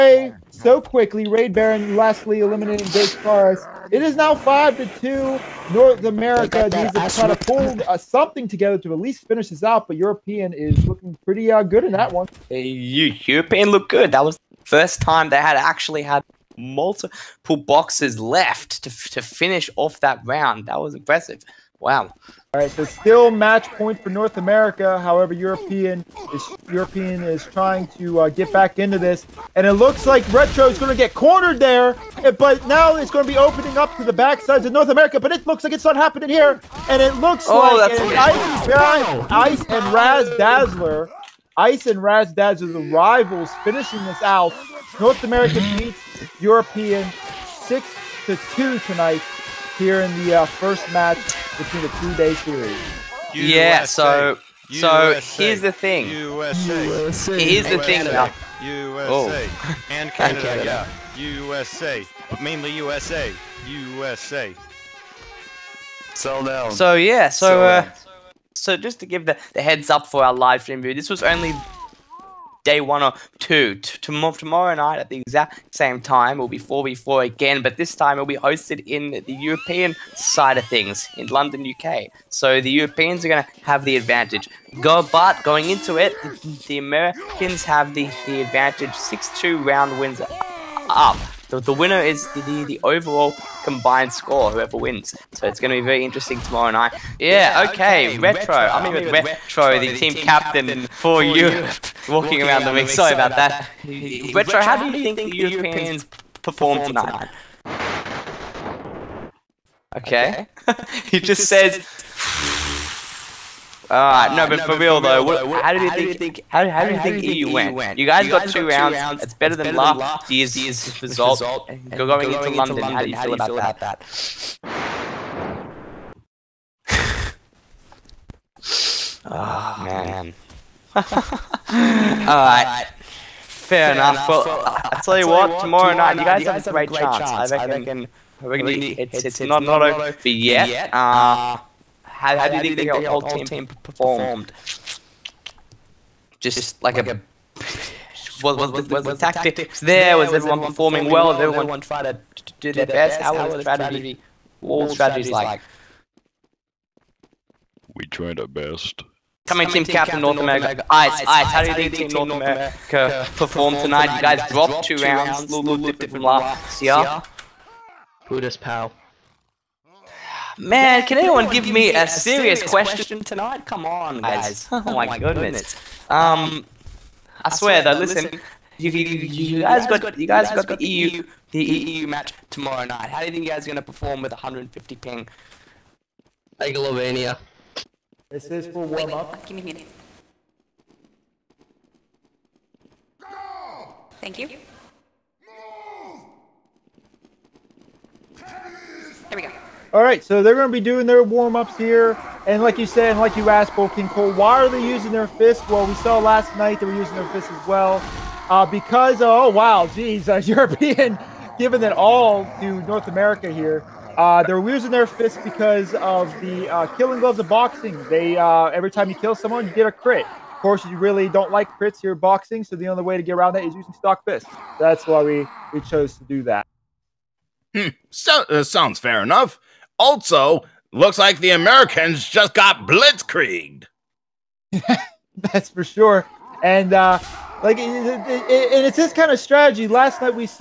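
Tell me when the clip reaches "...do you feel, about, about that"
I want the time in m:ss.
2:03.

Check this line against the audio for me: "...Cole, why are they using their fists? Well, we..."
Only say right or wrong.
right.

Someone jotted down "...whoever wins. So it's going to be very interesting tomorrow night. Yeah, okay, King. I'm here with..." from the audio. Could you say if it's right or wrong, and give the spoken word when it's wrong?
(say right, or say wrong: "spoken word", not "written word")
wrong: "Retro", not "King".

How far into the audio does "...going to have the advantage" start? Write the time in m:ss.
1:23.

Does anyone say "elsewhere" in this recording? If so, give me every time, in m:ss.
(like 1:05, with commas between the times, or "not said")
not said.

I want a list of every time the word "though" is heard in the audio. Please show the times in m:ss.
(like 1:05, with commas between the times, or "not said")
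1:55, 2:57.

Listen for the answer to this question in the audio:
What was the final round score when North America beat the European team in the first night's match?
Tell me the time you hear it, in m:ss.
0:47.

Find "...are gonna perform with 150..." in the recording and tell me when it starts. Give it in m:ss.
3:03.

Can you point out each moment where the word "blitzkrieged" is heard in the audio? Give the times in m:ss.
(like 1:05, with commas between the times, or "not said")
3:52.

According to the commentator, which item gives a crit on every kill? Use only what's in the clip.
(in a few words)
Killing Gloves of Boxing.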